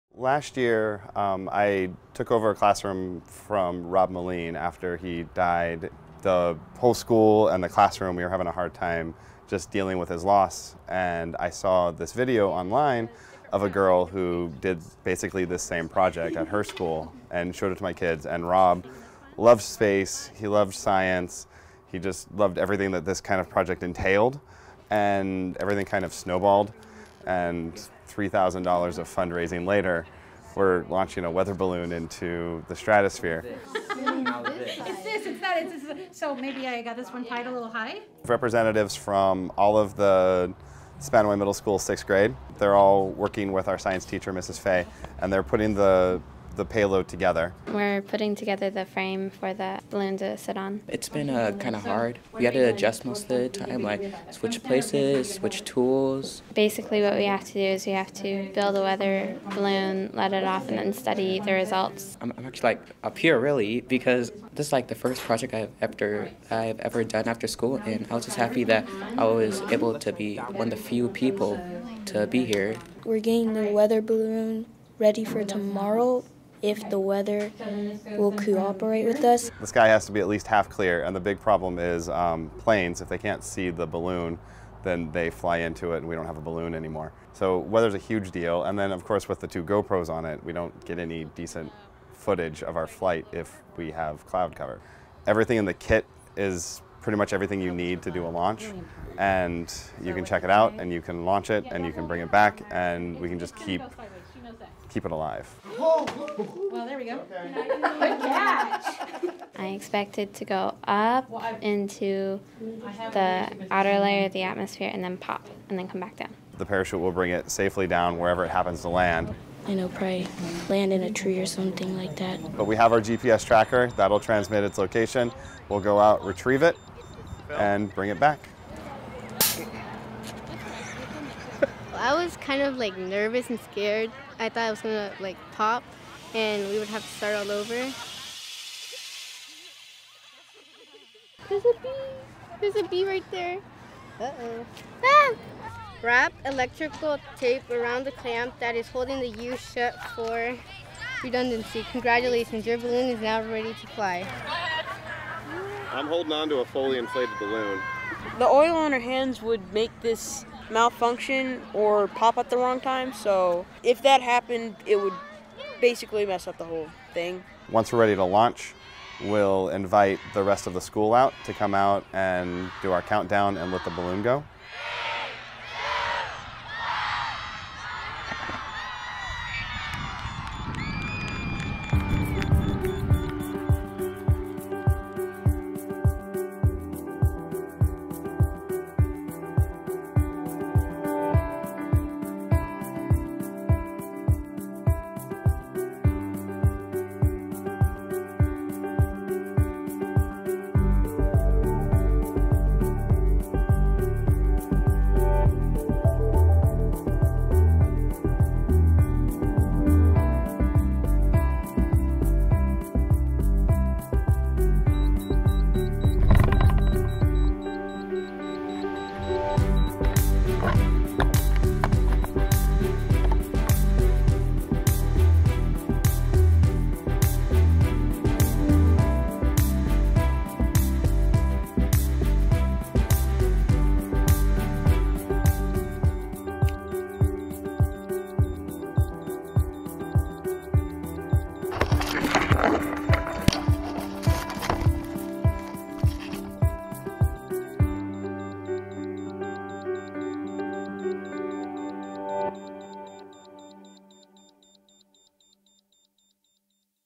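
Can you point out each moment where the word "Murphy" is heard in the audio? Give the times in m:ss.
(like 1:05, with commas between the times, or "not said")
not said.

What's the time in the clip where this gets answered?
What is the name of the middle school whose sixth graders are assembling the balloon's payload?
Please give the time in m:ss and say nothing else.
0:40.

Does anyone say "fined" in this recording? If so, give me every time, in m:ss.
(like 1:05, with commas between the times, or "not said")
not said.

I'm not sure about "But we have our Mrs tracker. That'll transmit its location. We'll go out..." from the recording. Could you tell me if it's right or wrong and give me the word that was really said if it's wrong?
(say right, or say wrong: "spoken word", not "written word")
wrong: "GPS", not "Mrs".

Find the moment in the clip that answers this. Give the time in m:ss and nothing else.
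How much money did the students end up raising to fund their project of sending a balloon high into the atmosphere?
0:28.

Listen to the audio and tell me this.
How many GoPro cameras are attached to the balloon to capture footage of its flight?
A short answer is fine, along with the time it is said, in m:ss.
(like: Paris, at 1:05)
2, at 1:29.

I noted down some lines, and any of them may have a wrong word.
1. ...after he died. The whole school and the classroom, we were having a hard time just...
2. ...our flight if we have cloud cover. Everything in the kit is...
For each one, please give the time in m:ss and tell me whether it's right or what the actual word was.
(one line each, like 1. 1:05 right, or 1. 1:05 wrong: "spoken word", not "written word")
1. 0:04 right
2. 1:32 right.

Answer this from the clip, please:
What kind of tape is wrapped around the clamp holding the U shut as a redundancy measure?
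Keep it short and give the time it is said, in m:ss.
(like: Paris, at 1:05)
Electrical tape, at 2:26.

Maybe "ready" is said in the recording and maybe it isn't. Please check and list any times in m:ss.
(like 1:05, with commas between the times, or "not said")
1:14, 2:33, 2:47.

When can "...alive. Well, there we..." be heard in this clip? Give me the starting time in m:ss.
1:45.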